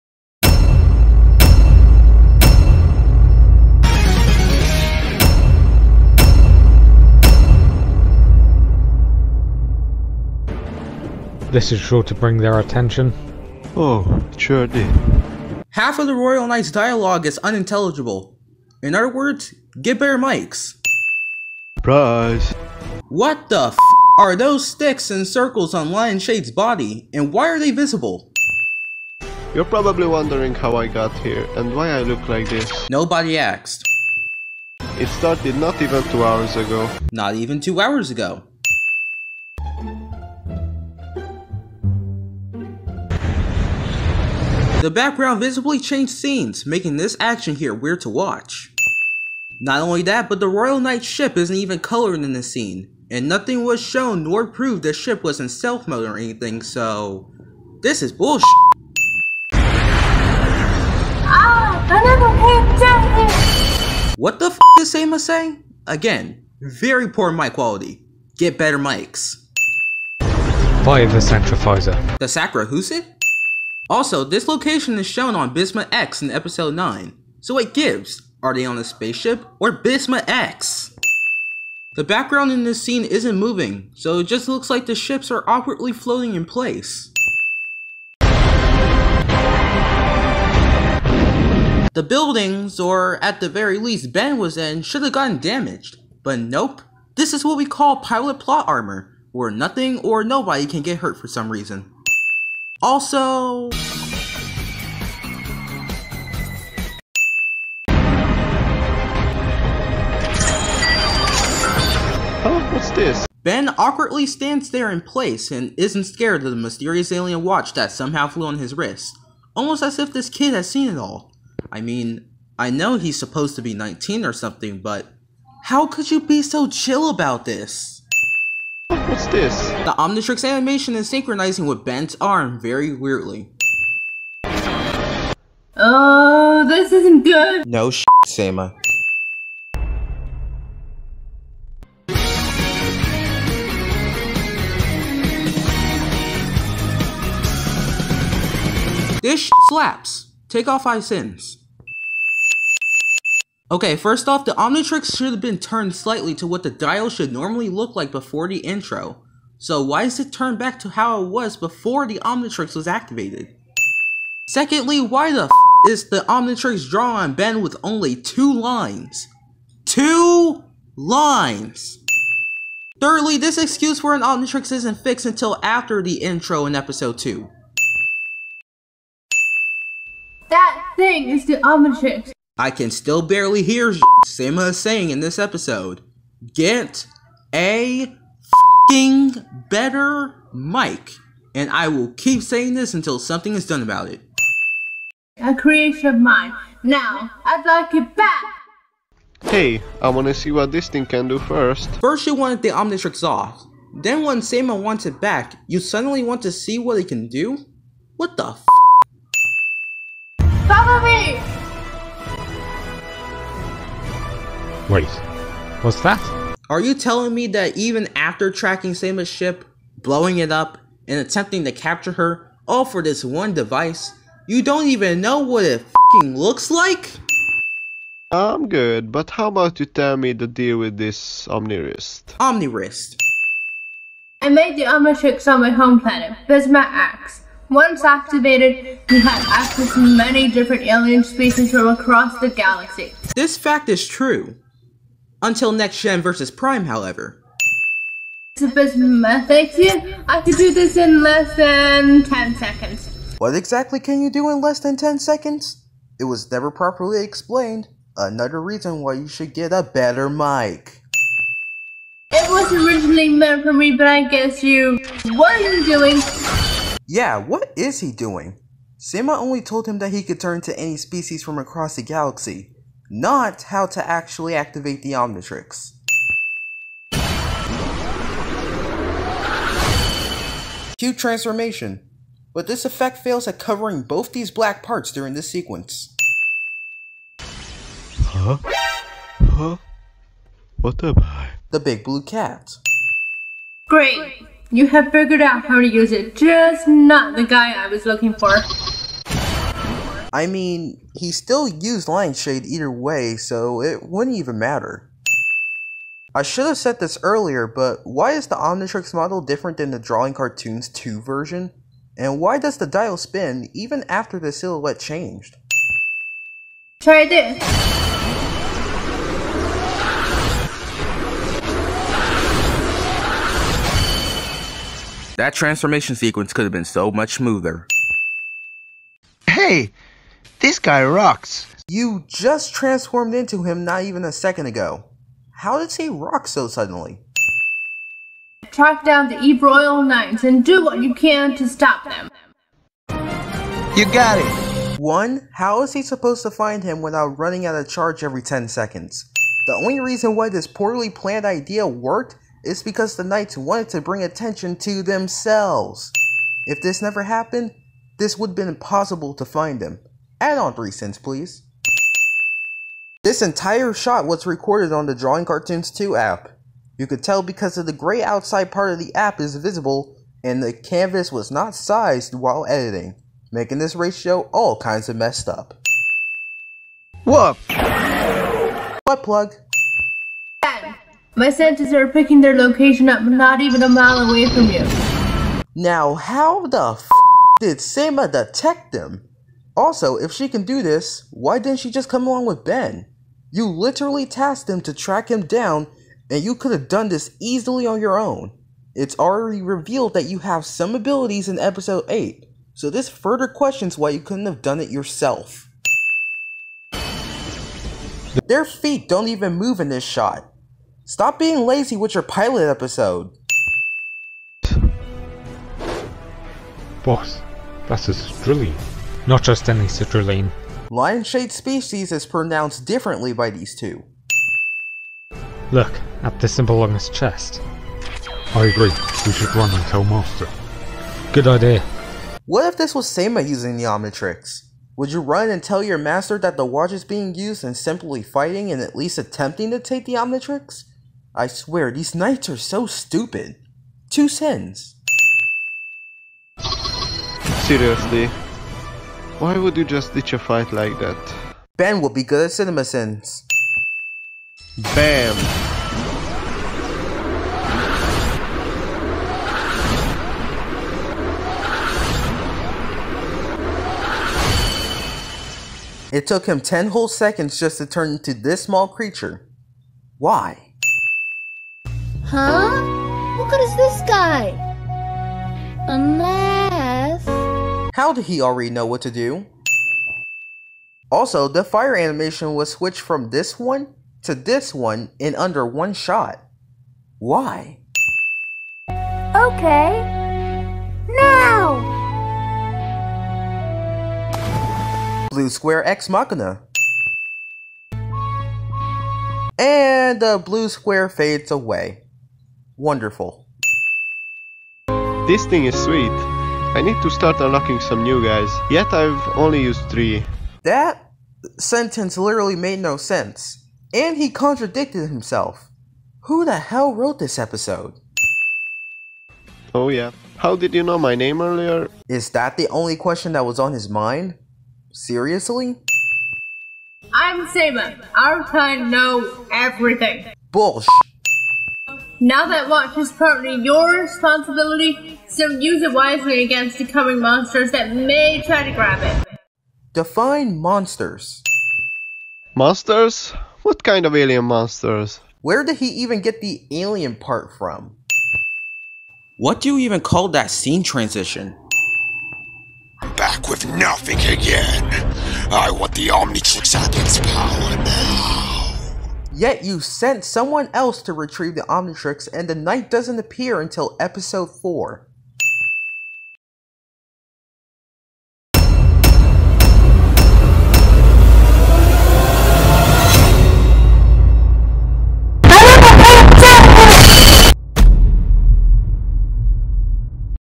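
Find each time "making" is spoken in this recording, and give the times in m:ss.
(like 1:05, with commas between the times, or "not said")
0:46, 6:13.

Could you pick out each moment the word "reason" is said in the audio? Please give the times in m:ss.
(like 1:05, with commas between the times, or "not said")
1:41, 4:18, 5:49.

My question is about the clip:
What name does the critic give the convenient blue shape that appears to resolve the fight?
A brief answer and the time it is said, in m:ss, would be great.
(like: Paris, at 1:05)
Blue Square Ex Machina, at 8:15.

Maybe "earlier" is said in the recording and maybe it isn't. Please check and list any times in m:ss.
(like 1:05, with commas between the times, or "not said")
5:07, 8:41.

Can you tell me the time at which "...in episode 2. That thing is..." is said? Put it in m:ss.
2:56.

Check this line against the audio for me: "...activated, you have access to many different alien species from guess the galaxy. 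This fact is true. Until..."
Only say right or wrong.
wrong.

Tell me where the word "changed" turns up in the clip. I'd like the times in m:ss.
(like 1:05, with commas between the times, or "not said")
0:45, 5:14.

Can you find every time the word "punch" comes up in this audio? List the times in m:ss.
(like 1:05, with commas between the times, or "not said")
not said.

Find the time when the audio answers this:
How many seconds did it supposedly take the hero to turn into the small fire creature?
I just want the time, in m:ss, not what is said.
7:46.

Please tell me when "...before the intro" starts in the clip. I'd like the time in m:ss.
2:38.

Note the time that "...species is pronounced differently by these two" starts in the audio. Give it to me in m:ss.
7:01.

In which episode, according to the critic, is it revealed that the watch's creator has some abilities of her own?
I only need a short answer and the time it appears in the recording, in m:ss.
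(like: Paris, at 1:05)
episode 8, at 6:41.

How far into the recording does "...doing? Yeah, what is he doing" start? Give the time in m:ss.
4:25.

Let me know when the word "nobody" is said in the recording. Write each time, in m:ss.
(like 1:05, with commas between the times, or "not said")
0:32, 1:40.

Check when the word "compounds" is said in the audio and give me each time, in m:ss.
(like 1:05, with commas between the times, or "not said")
not said.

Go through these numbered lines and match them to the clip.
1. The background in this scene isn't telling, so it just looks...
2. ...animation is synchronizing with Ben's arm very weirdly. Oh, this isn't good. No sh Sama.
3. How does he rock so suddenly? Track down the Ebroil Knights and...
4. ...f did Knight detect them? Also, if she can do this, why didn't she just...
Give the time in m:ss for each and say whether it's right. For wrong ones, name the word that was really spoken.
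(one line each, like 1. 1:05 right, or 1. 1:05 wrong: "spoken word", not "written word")
1. 1:21 wrong: "moving", not "telling"
2. 2:10 right
3. 5:35 right
4. 6:26 wrong: "Sema", not "Knight".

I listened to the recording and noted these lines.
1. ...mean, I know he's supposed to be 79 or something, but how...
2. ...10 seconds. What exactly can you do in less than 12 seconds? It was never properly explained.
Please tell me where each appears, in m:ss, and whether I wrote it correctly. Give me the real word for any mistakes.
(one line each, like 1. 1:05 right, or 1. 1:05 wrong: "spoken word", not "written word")
1. 2:01 wrong: "19", not "79"
2. 4:12 wrong: "10", not "12".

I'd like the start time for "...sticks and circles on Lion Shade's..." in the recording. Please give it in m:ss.
0:24.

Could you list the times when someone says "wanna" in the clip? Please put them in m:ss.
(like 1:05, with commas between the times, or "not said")
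3:20.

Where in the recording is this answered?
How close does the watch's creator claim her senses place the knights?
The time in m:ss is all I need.
6:23.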